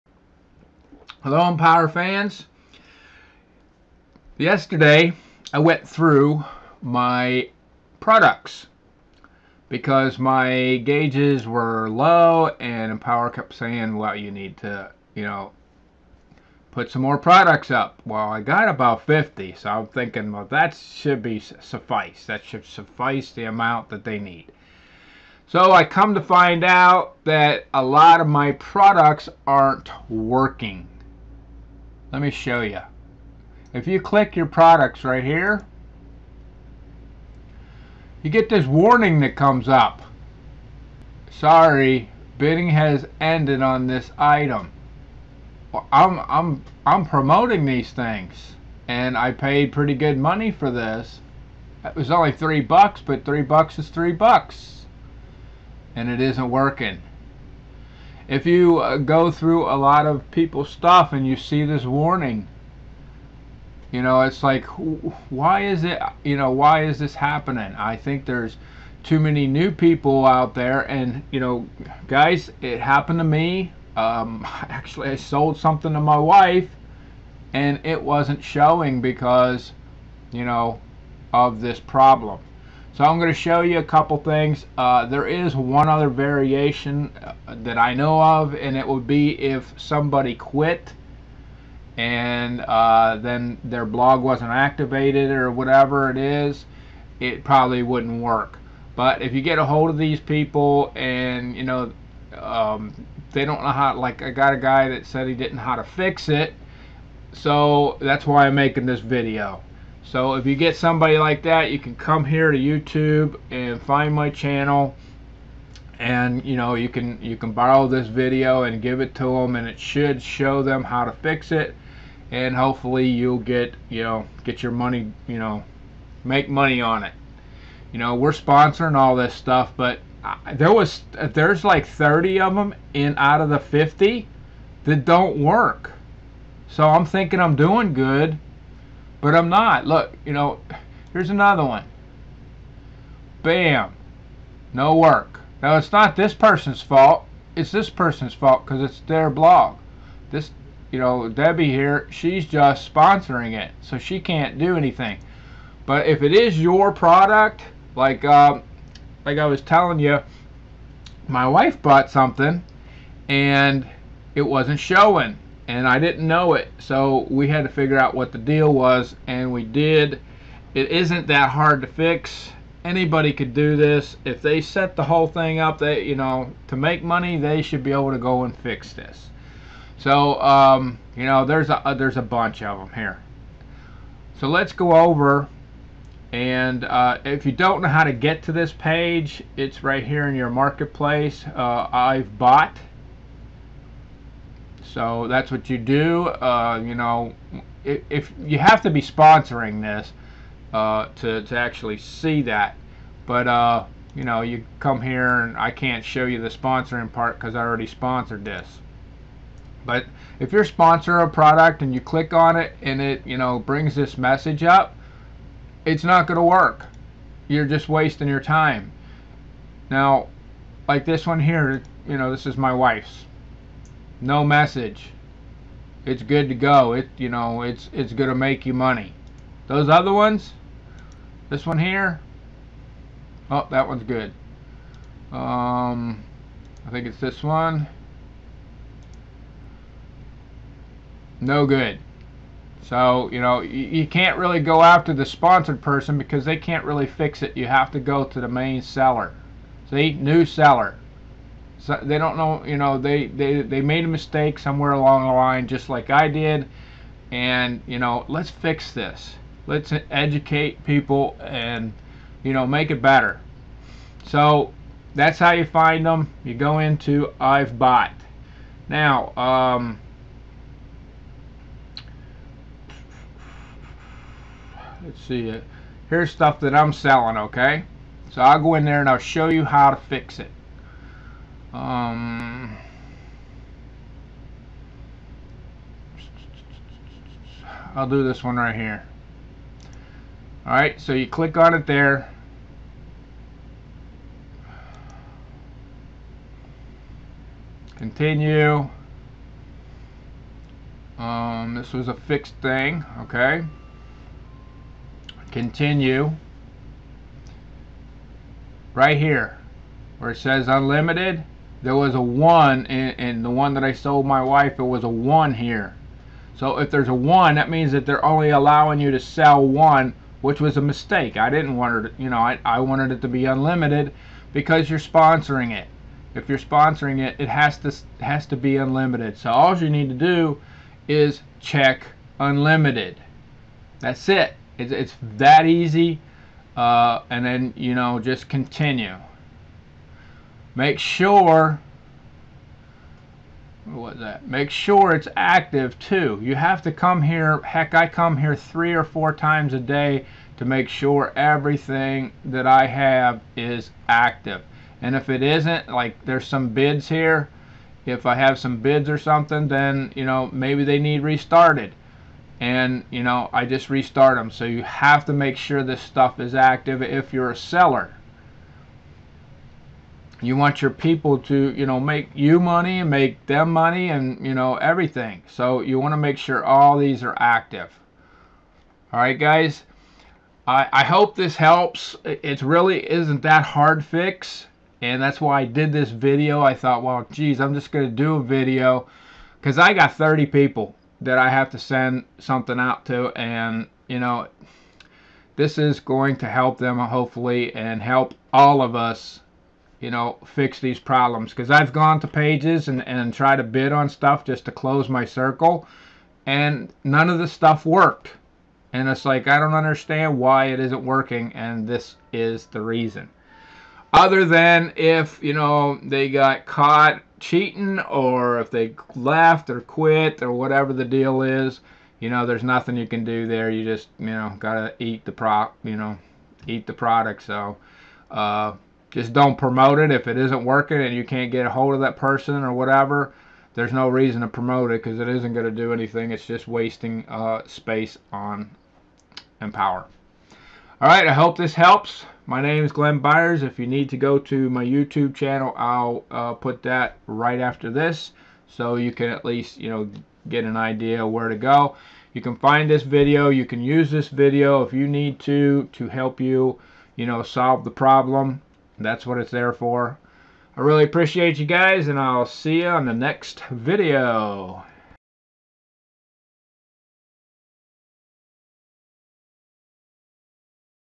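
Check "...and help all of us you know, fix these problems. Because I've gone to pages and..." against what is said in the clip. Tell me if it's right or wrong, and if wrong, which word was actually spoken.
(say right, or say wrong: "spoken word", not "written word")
right.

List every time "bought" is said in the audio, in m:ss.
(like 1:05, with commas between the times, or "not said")
2:41, 3:12, 4:27.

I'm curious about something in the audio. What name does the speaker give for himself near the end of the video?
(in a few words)
Glenn Byers.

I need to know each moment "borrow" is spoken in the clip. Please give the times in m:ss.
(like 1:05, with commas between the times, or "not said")
1:57.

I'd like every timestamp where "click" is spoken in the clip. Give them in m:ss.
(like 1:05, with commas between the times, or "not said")
0:34, 3:32, 4:51.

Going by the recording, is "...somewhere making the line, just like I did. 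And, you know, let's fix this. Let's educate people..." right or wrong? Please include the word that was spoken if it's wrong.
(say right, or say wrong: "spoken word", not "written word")
wrong: "along", not "making".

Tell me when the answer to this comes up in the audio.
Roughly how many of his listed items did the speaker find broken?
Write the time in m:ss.
2:11.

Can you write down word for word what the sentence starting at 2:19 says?
Look, you know, here's another one.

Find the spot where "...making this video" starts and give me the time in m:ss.
1:48.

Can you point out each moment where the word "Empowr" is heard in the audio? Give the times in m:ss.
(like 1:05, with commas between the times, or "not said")
0:01, 0:12, 7:19.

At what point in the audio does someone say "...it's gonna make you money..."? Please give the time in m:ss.
3:47.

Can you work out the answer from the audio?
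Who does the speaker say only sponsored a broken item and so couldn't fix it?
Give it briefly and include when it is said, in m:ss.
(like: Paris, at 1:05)
Debbie, at 2:31.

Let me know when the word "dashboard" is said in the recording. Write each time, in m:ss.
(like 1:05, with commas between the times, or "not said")
not said.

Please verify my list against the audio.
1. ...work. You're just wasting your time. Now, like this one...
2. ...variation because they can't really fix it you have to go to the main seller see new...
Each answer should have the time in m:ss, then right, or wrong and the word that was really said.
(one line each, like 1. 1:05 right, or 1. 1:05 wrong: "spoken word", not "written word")
1. 3:36 right
2. 4:05 wrong: "person", not "variation".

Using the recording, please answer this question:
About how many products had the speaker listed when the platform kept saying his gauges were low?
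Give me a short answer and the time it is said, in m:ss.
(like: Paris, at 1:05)
50, at 0:18.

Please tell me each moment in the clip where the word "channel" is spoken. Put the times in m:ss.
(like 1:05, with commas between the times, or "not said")
1:54, 7:25.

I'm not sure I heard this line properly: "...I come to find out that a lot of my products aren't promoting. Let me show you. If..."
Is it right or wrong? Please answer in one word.
wrong.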